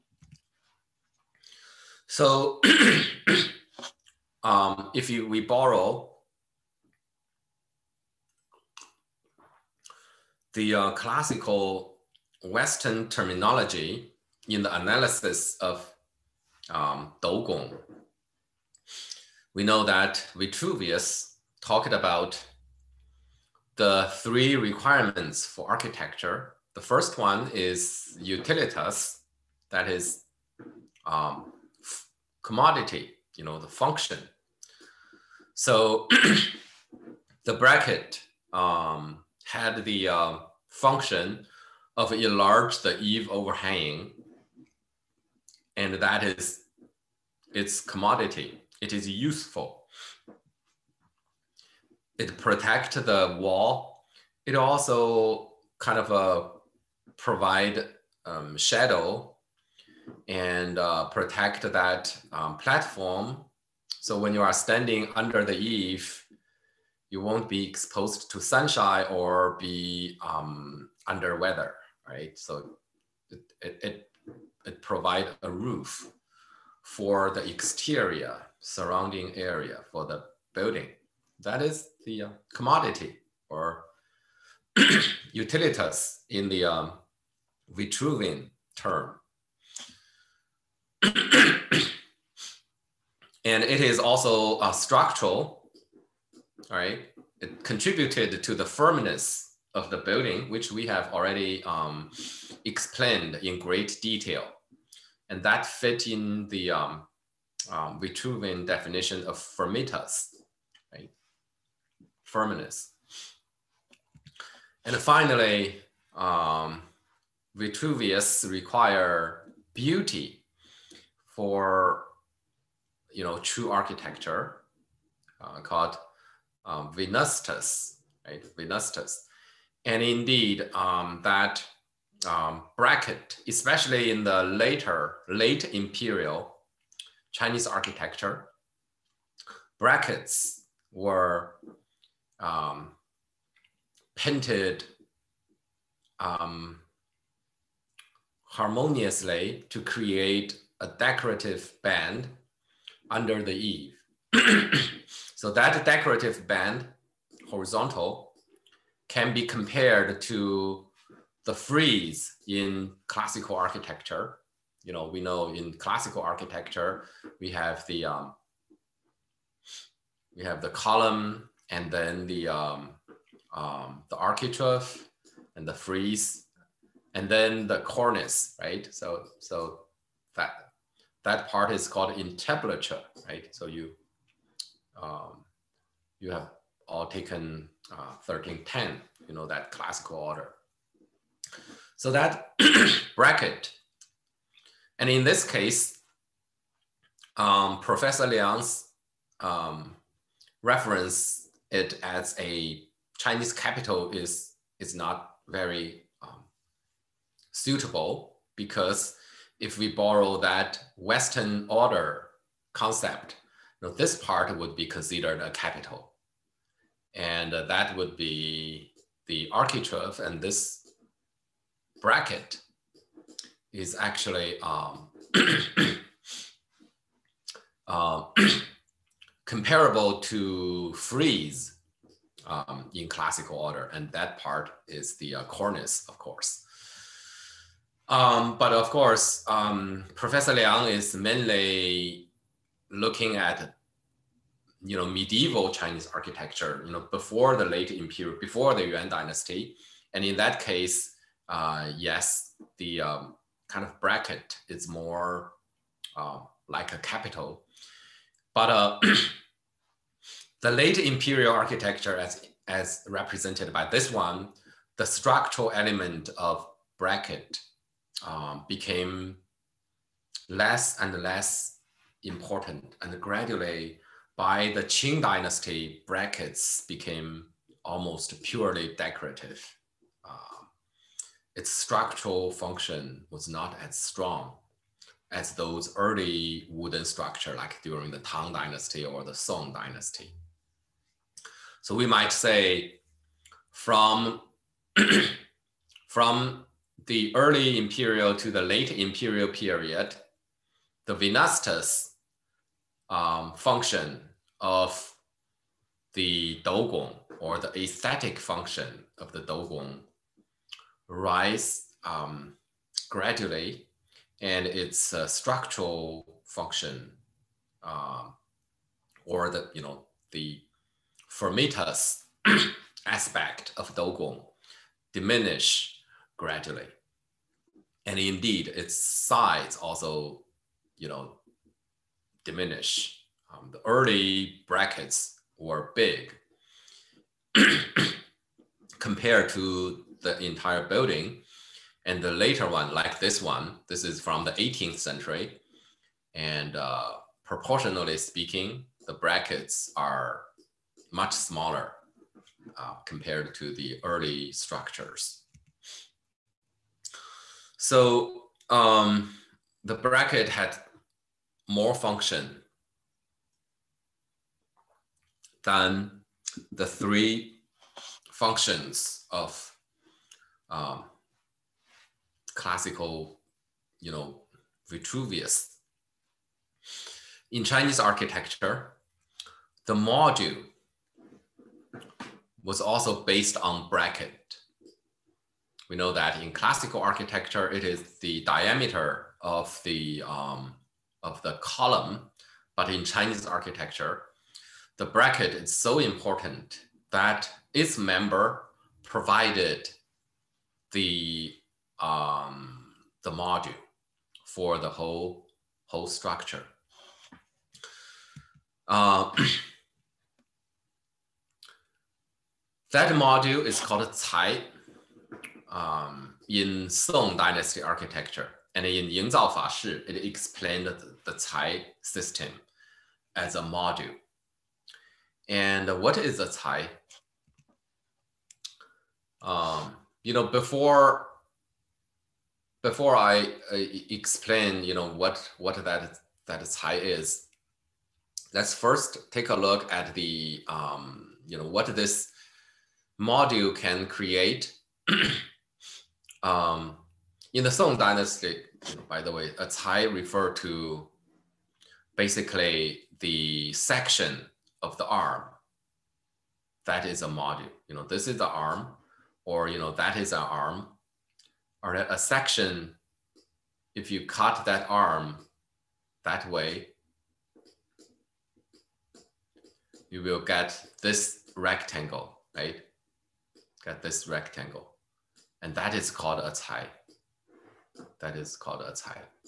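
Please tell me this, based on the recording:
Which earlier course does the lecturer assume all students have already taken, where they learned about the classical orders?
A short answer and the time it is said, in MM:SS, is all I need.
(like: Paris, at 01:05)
1310, at 03:08.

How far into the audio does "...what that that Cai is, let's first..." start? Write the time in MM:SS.
07:15.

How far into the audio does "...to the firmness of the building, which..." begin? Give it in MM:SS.
01:38.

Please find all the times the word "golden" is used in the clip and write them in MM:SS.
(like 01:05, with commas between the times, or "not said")
not said.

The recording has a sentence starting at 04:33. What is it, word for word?
And gradually, by the Qing dynasty, brackets became almost purely decorative.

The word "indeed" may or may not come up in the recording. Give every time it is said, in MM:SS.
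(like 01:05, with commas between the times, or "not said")
02:10, 05:28.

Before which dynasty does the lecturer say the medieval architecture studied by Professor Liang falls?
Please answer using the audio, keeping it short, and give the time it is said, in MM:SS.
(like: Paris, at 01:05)
Yuan dynasty, at 04:08.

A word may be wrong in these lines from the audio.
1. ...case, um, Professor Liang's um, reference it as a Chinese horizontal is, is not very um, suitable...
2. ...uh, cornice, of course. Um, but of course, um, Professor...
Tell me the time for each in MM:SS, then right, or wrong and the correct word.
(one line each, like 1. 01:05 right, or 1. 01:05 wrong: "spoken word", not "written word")
1. 03:15 wrong: "capital", not "horizontal"
2. 03:55 right.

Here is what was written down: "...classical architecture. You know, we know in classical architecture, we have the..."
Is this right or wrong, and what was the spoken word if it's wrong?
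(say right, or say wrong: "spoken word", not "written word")
right.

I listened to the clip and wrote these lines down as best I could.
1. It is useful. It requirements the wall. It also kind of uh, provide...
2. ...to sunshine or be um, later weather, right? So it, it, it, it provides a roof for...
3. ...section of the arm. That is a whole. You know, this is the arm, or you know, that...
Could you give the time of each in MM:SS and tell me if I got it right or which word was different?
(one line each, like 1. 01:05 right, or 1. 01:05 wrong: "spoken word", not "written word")
1. 00:48 wrong: "protects", not "requirements"
2. 01:08 wrong: "under", not "later"
3. 07:33 wrong: "module", not "whole".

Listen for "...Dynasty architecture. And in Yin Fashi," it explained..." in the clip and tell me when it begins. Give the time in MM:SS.
06:57.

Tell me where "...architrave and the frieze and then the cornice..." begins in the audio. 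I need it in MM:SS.
02:54.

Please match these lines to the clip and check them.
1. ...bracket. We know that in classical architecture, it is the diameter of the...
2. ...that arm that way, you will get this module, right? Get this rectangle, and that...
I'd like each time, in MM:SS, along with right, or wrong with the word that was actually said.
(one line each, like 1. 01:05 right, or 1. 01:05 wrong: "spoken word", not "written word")
1. 06:23 right
2. 07:44 wrong: "rectangle", not "module".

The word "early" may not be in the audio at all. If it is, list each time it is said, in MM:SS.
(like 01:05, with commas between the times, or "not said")
04:45, 04:57, 05:33, 05:54.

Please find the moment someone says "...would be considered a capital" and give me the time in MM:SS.
03:34.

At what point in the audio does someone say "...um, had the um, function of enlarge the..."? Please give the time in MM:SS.
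00:38.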